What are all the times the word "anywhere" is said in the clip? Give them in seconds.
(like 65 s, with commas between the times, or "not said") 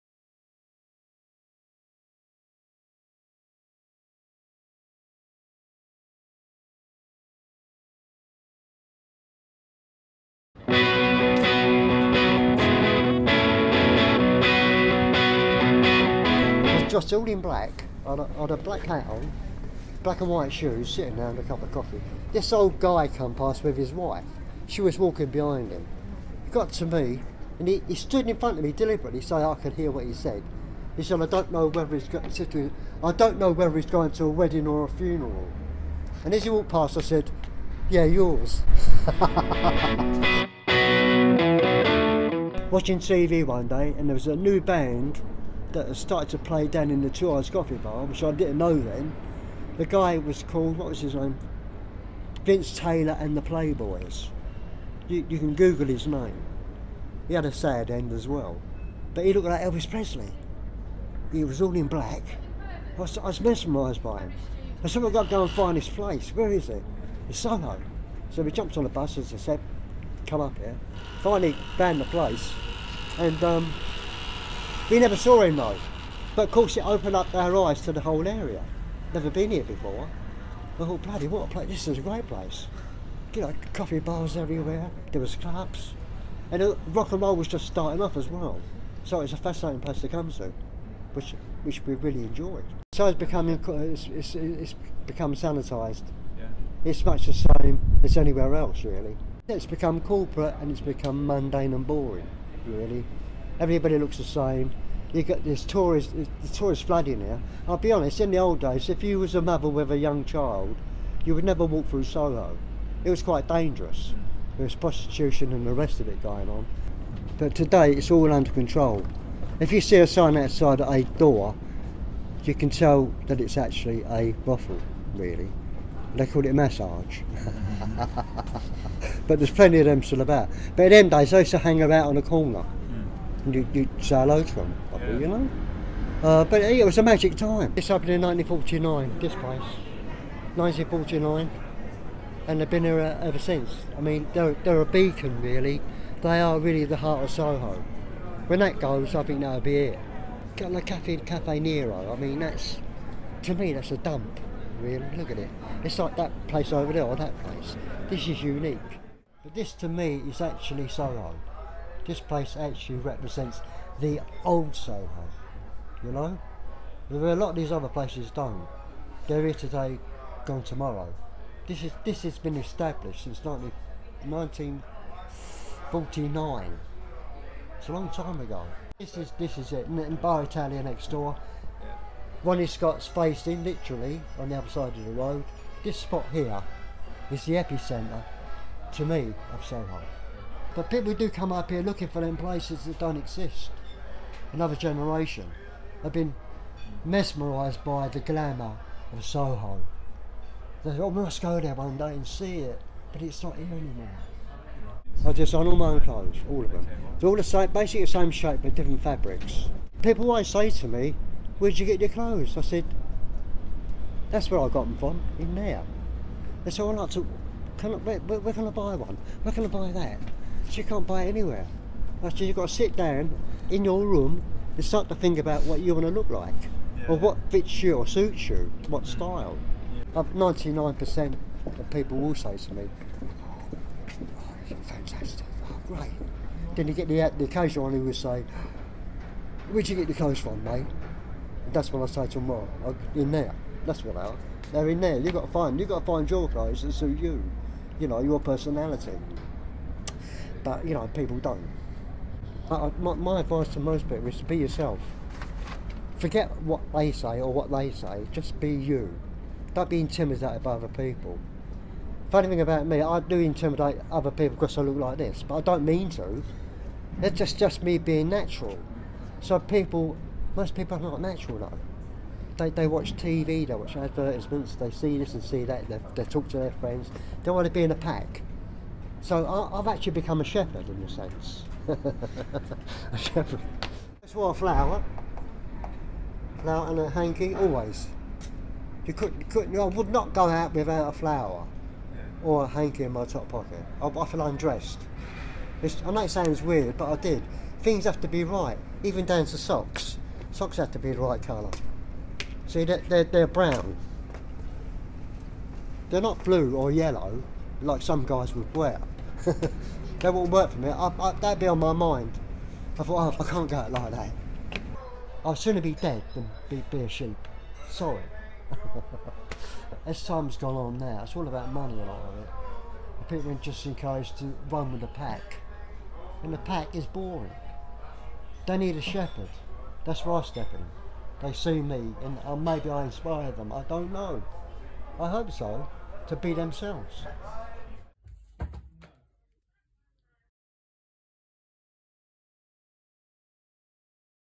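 98 s, 221 s.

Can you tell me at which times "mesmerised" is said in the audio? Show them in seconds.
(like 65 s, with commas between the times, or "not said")
63 s, 197 s.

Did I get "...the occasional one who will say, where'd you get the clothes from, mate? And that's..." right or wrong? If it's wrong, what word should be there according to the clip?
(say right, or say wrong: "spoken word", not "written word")
right.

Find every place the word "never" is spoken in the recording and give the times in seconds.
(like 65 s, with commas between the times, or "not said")
74 s, 79 s, 111 s.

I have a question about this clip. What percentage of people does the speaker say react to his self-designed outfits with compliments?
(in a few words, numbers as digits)
99%.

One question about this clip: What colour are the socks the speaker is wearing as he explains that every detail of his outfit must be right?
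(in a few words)
Brown.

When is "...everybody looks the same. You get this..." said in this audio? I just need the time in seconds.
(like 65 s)
103 s.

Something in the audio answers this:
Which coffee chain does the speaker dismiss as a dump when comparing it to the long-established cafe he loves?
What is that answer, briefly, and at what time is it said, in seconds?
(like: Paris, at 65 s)
Cafe Nero, at 151 s.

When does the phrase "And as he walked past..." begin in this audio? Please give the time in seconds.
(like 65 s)
36 s.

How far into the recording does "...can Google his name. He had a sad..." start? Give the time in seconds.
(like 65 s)
55 s.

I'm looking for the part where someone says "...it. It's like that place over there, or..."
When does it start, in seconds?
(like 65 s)
155 s.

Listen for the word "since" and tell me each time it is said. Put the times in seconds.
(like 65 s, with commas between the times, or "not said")
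143 s, 173 s.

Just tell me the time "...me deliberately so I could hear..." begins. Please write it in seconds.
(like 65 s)
28 s.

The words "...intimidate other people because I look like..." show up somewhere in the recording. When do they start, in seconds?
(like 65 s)
263 s.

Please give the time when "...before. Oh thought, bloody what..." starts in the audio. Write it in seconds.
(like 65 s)
79 s.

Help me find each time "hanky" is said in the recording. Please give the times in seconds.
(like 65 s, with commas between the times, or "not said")
287 s, 292 s.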